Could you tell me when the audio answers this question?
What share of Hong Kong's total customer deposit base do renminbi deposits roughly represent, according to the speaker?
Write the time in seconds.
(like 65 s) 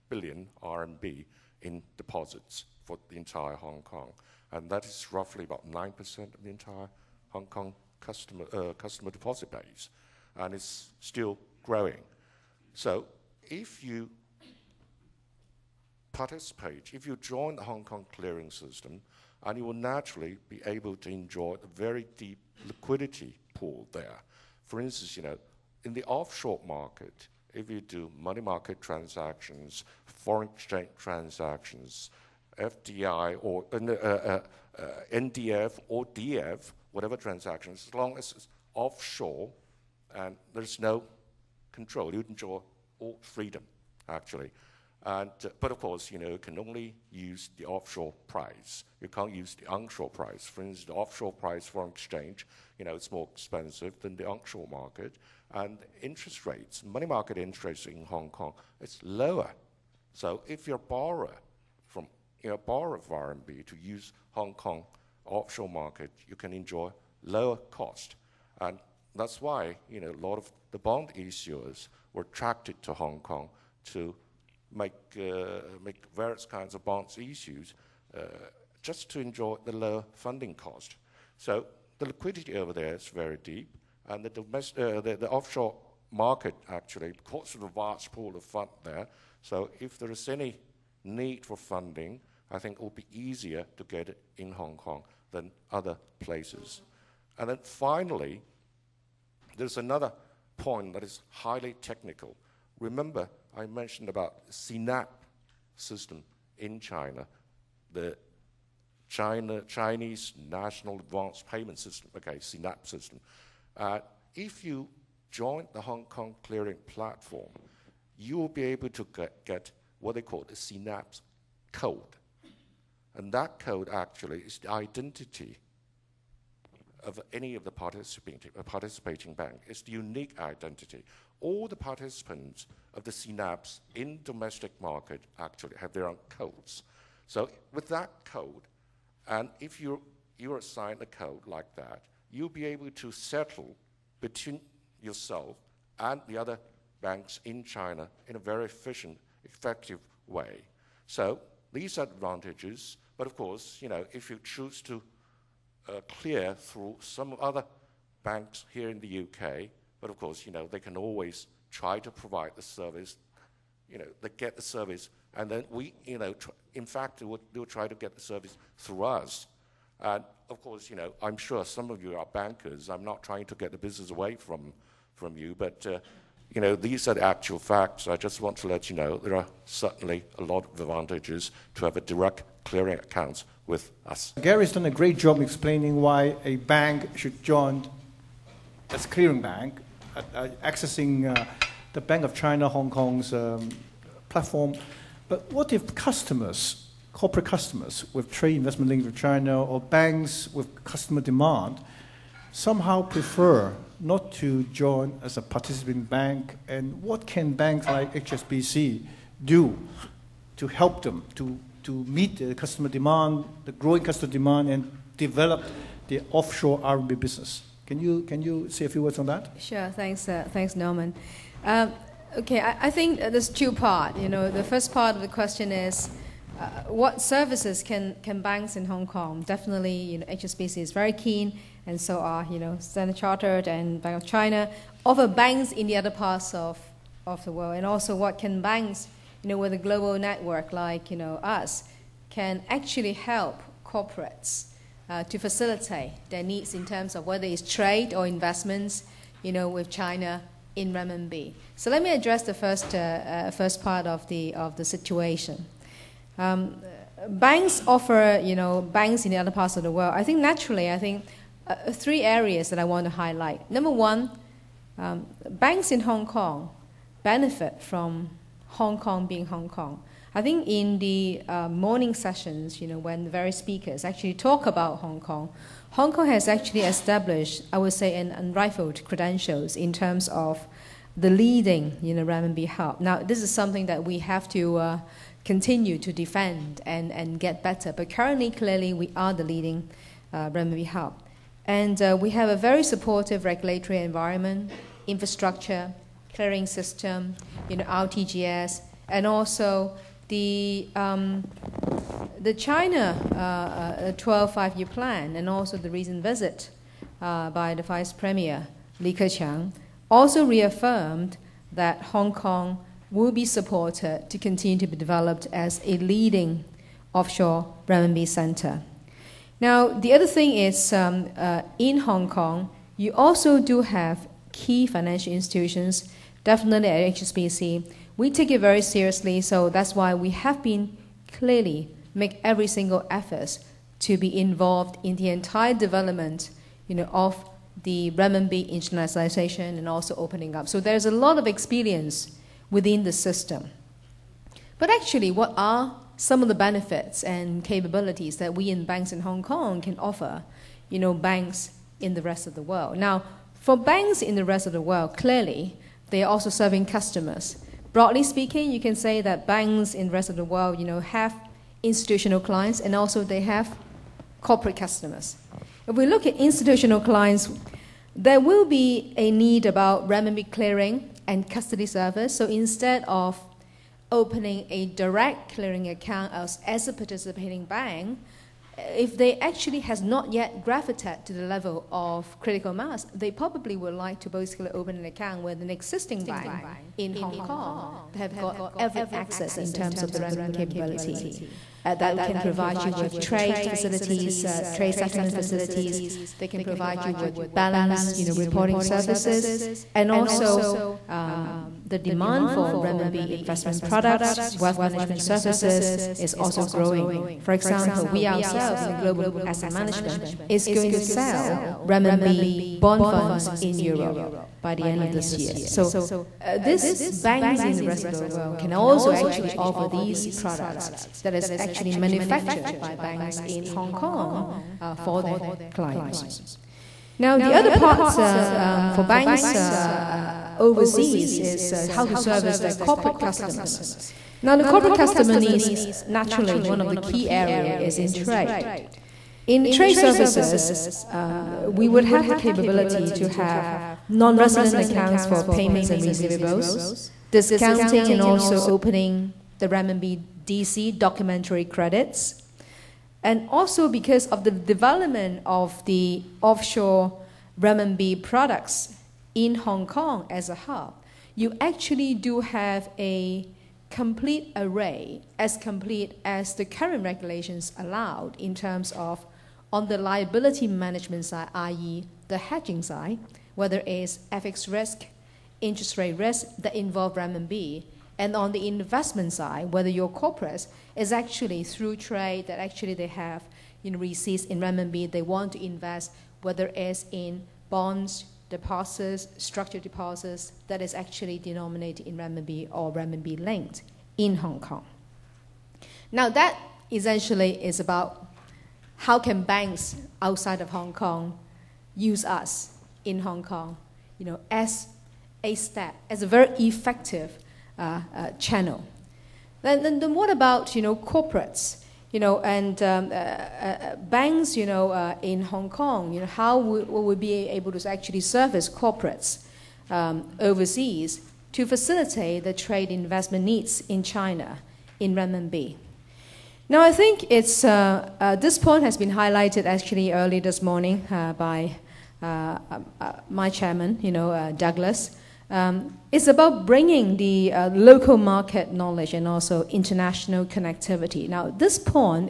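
5 s.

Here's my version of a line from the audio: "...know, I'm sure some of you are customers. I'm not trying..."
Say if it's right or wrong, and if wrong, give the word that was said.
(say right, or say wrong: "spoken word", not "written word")
wrong: "bankers", not "customers".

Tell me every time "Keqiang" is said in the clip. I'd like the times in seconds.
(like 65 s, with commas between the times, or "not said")
309 s.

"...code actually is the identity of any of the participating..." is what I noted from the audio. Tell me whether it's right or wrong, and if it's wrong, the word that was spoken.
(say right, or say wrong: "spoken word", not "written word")
right.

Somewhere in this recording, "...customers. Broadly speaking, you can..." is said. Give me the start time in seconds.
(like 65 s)
356 s.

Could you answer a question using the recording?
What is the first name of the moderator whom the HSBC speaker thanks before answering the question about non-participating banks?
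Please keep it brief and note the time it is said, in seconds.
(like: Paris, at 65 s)
Norman, at 220 s.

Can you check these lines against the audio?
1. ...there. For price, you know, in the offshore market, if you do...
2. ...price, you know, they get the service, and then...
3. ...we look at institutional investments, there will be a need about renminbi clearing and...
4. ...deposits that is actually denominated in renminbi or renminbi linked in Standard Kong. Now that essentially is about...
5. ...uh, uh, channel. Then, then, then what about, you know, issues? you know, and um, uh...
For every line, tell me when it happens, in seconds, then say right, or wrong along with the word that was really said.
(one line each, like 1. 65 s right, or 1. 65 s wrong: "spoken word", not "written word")
1. 23 s wrong: "instance", not "price"
2. 162 s wrong: "service", not "price"
3. 365 s wrong: "clients", not "investments"
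4. 489 s wrong: "Hong", not "Standard"
5. 507 s wrong: "corporates", not "issues".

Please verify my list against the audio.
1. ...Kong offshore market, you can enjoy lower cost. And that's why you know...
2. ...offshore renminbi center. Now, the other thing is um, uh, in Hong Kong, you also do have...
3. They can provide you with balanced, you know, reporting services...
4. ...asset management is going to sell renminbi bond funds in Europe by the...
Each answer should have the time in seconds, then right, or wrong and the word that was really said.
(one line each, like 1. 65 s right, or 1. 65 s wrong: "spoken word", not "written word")
1. 64 s right
2. 317 s right
3. 396 s right
4. 409 s right.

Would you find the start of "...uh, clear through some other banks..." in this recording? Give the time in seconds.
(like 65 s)
155 s.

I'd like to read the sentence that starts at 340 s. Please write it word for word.
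So there's a lot of experience within the system.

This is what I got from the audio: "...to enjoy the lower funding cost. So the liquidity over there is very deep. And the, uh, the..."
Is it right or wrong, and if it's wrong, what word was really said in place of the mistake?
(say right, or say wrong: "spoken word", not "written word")
right.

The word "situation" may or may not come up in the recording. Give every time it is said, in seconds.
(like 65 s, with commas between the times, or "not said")
254 s.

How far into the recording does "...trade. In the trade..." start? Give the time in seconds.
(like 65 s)
438 s.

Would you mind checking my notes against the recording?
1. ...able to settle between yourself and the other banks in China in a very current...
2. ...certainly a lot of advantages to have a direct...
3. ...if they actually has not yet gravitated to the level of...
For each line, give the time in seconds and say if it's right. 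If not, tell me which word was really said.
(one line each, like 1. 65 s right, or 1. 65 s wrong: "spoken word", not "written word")
1. 142 s wrong: "efficient", not "current"
2. 179 s right
3. 378 s right.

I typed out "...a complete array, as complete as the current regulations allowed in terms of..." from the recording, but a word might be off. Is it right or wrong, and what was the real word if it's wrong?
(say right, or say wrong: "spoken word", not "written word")
right.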